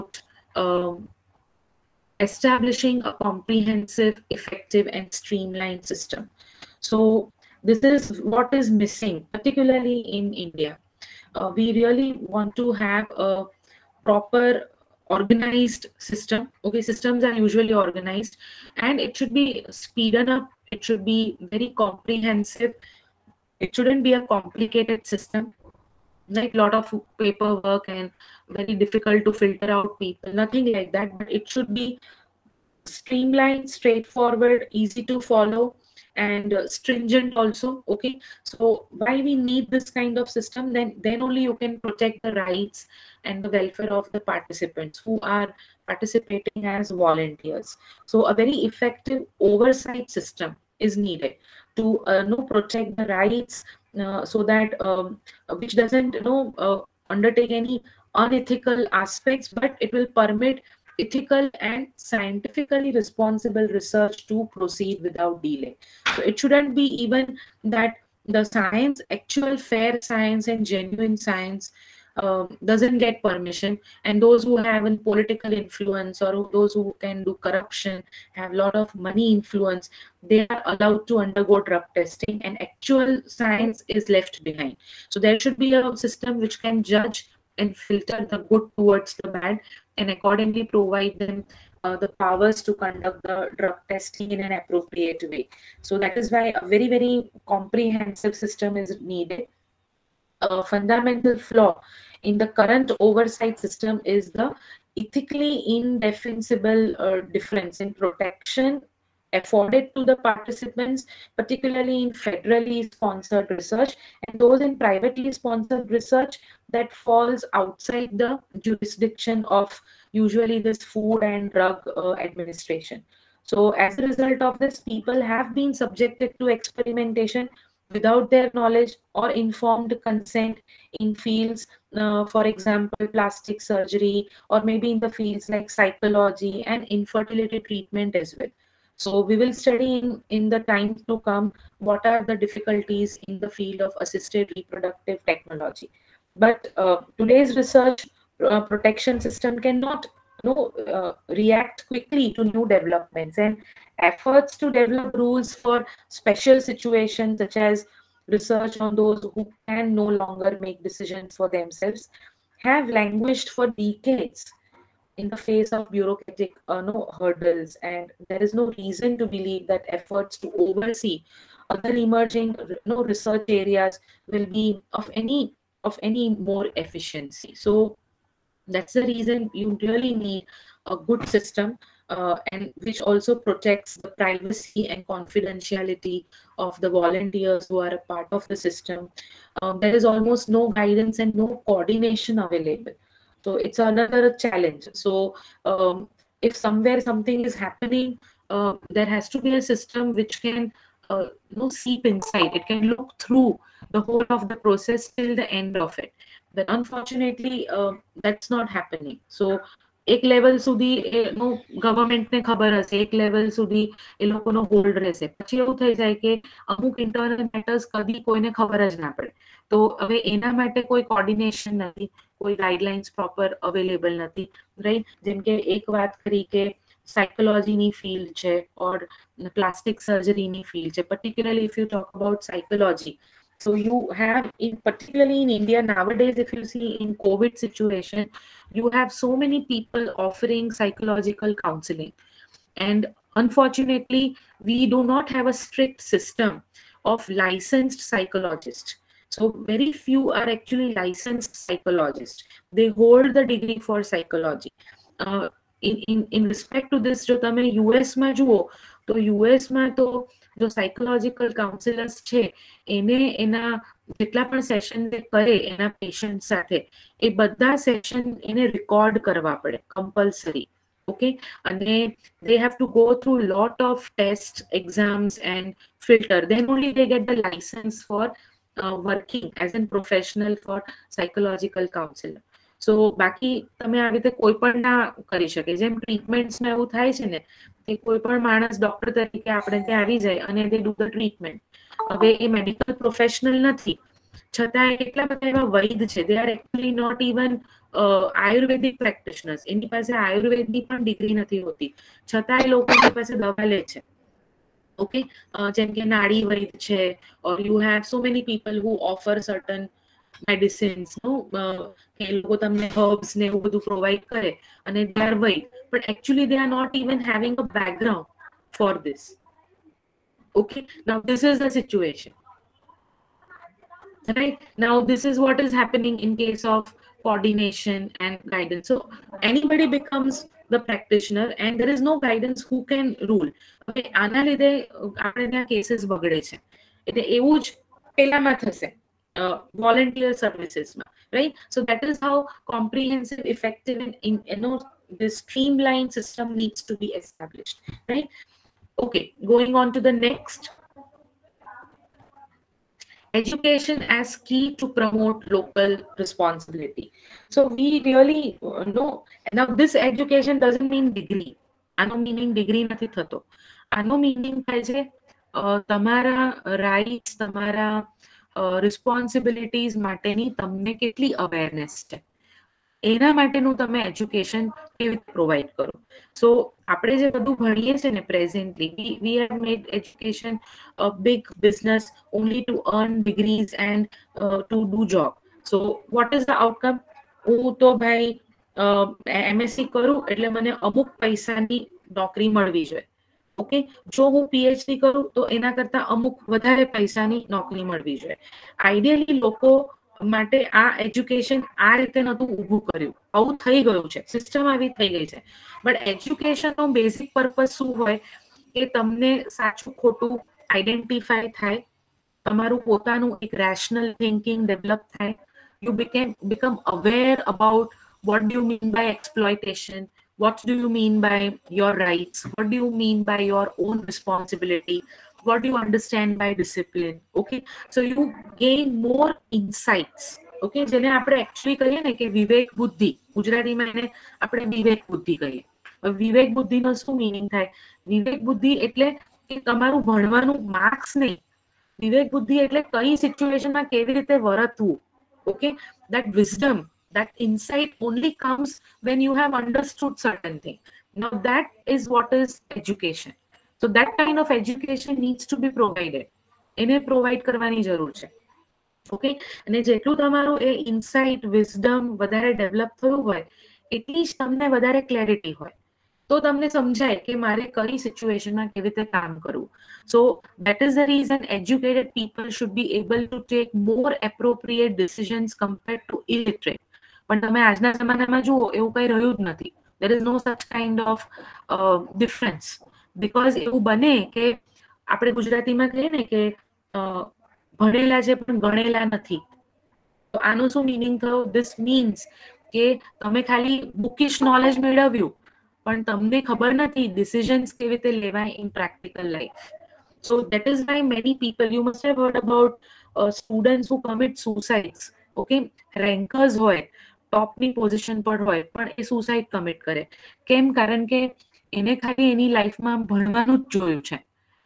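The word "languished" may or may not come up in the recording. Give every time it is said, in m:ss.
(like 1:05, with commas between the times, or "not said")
2:42.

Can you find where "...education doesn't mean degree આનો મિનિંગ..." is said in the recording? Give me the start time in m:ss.
6:00.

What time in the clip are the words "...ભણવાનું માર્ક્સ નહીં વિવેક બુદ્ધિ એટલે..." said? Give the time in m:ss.
7:20.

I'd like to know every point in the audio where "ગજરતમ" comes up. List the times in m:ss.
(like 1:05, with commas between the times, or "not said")
7:13, 8:05.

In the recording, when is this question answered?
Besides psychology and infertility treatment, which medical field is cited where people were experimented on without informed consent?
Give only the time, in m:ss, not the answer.
2:13.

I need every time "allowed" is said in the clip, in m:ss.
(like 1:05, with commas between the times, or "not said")
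1:20.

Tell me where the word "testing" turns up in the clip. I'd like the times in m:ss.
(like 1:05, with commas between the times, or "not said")
1:21, 1:33.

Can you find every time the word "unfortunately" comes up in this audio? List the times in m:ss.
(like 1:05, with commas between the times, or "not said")
3:26, 4:03.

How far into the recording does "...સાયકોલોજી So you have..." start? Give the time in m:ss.
3:52.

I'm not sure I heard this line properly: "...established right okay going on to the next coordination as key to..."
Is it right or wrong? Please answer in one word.
wrong.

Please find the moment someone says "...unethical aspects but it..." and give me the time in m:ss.
0:58.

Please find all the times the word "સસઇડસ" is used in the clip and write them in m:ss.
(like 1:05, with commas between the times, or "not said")
8:24.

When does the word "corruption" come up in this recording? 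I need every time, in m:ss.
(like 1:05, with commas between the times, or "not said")
1:17.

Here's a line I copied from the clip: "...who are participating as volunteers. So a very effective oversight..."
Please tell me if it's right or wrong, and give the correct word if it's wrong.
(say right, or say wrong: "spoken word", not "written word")
right.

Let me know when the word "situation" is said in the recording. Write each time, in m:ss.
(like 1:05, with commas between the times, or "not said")
2:36, 3:57, 5:21.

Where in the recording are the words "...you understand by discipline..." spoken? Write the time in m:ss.
7:05.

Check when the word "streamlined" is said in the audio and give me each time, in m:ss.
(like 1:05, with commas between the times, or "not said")
0:05, 0:32, 5:45.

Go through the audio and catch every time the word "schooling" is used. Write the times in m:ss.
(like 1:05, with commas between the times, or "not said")
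not said.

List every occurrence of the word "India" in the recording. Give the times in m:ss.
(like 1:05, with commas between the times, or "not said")
0:10, 3:55.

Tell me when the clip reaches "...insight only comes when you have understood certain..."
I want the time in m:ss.
7:27.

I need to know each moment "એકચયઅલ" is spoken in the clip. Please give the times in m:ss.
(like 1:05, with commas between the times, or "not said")
5:16, 7:11.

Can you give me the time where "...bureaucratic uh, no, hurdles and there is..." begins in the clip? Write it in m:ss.
2:45.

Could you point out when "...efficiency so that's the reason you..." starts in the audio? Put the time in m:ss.
2:56.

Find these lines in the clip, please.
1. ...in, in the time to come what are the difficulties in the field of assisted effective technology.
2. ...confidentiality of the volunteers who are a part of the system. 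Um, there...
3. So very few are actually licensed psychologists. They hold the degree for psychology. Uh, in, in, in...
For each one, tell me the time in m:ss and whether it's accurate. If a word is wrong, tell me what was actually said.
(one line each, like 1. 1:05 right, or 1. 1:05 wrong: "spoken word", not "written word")
1. 2:19 wrong: "reproductive", not "effective"
2. 3:05 right
3. 4:09 right.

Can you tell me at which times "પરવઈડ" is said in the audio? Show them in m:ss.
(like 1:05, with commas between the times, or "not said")
5:13, 6:15, 7:37.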